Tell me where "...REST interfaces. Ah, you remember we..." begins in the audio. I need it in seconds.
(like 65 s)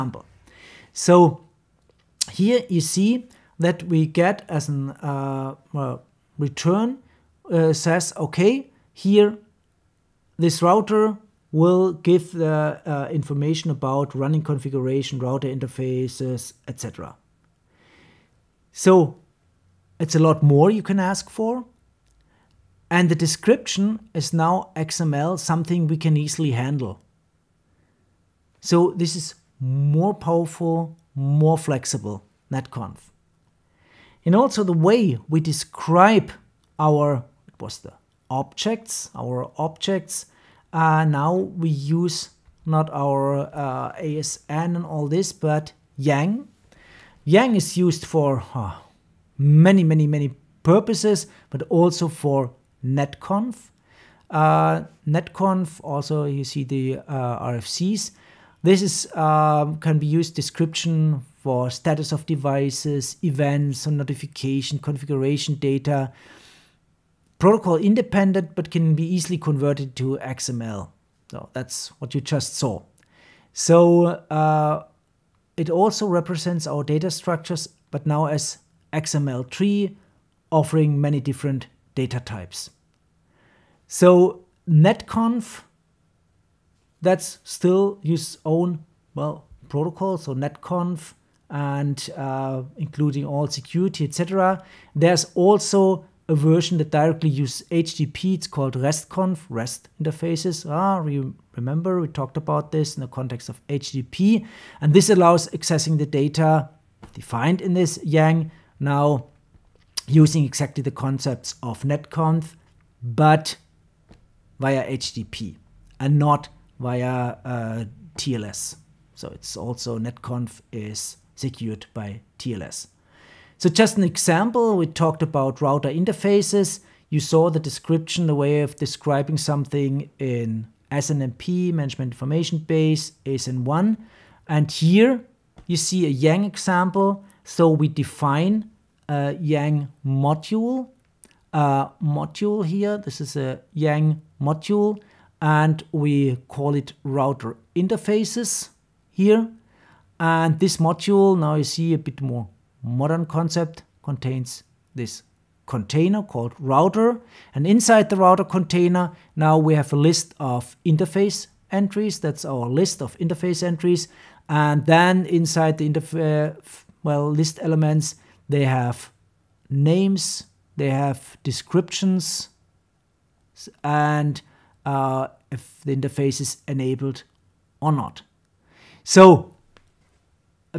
99 s.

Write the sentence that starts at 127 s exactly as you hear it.
You saw the description, the way of describing something in SNMP, Management Information Base, ASN1.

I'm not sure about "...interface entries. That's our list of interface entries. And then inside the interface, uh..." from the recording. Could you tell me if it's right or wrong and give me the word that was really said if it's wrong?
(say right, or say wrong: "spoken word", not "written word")
right.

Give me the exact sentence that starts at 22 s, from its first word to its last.
And the description is now XML, something we can easily handle.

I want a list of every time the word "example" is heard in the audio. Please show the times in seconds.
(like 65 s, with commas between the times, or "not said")
124 s, 136 s.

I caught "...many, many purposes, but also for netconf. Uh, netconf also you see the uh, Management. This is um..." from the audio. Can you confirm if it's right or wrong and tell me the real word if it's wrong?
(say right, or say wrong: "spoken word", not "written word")
wrong: "RFCs", not "Management".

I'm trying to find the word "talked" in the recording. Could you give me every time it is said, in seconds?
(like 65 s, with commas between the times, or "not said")
102 s, 124 s.